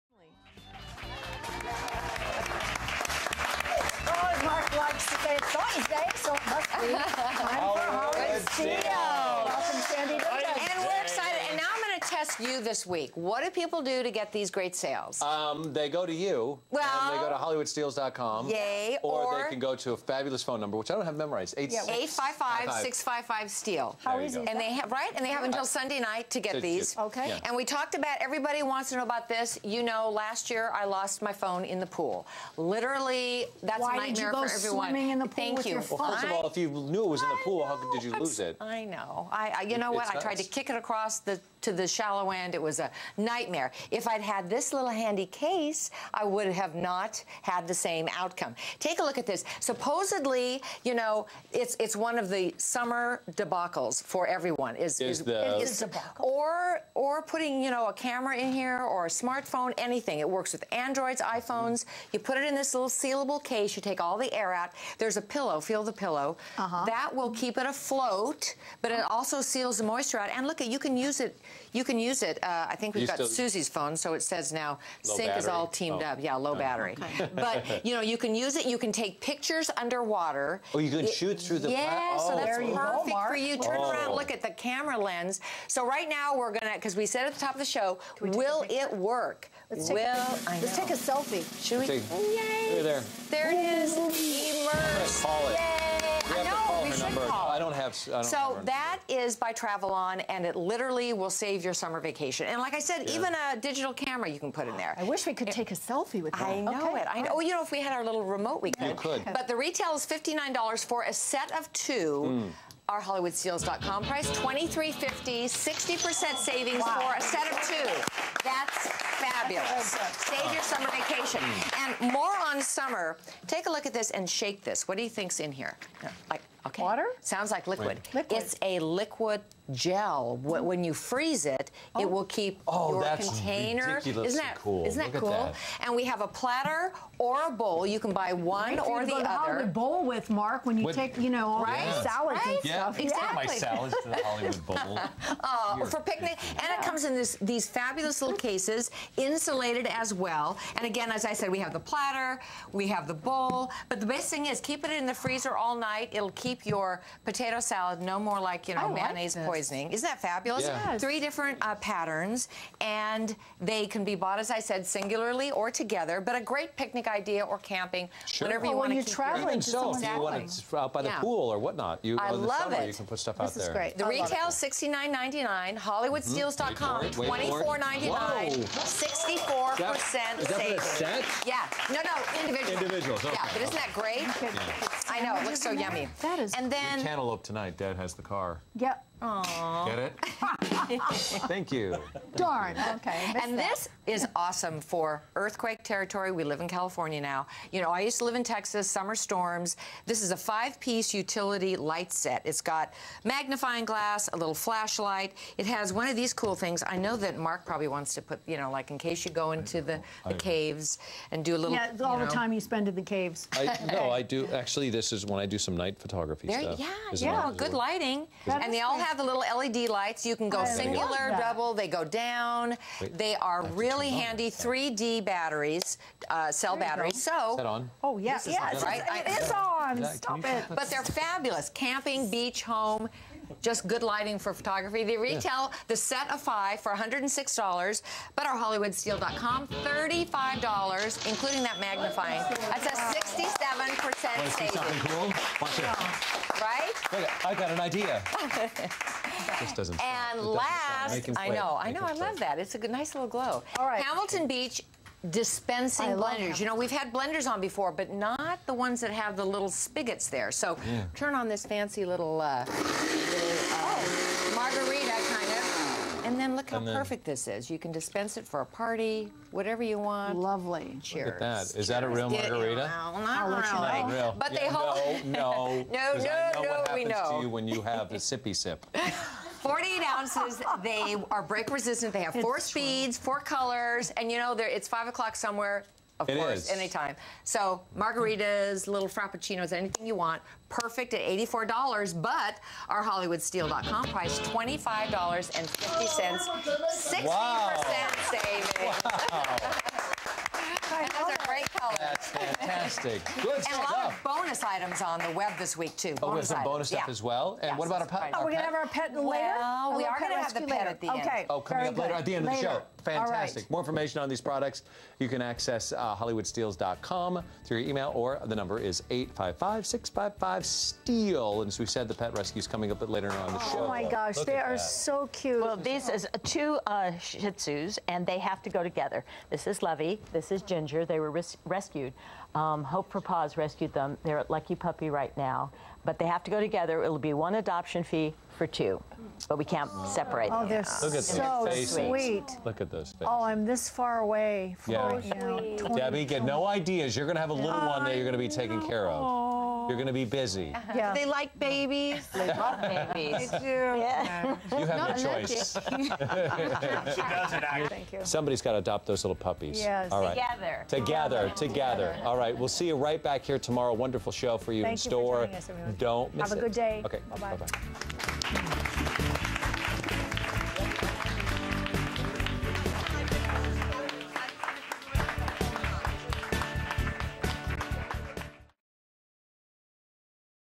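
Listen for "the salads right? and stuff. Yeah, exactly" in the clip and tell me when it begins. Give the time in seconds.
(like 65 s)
141 s.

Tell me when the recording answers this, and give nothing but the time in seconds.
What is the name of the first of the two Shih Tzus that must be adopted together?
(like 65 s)
329 s.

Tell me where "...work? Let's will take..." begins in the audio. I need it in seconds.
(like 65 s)
88 s.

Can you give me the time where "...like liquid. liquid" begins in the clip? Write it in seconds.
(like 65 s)
127 s.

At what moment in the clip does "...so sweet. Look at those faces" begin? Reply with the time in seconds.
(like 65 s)
341 s.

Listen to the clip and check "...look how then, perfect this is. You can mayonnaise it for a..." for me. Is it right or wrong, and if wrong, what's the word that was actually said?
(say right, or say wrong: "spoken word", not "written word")
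wrong: "dispense", not "mayonnaise".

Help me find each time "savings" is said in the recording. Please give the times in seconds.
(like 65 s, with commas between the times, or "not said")
116 s, 180 s, 244 s, 298 s.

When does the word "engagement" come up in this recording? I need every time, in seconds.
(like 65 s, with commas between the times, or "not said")
not said.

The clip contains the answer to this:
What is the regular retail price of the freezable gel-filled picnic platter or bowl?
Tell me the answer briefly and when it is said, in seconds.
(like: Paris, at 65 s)
$69.99, at 174 s.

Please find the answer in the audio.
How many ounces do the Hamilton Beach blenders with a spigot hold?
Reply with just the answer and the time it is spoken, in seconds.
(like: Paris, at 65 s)
48, at 279 s.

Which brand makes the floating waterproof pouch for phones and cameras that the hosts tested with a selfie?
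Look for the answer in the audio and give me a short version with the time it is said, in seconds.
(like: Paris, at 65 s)
Travelon, at 99 s.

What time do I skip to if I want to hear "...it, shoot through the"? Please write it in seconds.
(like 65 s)
81 s.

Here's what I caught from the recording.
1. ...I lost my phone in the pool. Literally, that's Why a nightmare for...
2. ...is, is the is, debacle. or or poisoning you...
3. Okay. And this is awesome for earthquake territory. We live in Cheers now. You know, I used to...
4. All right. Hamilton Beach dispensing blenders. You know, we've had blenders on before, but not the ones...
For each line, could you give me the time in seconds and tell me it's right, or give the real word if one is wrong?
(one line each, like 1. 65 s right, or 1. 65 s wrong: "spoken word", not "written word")
1. 30 s right
2. 54 s wrong: "putting", not "poisoning"
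3. 192 s wrong: "California", not "Cheers"
4. 253 s right.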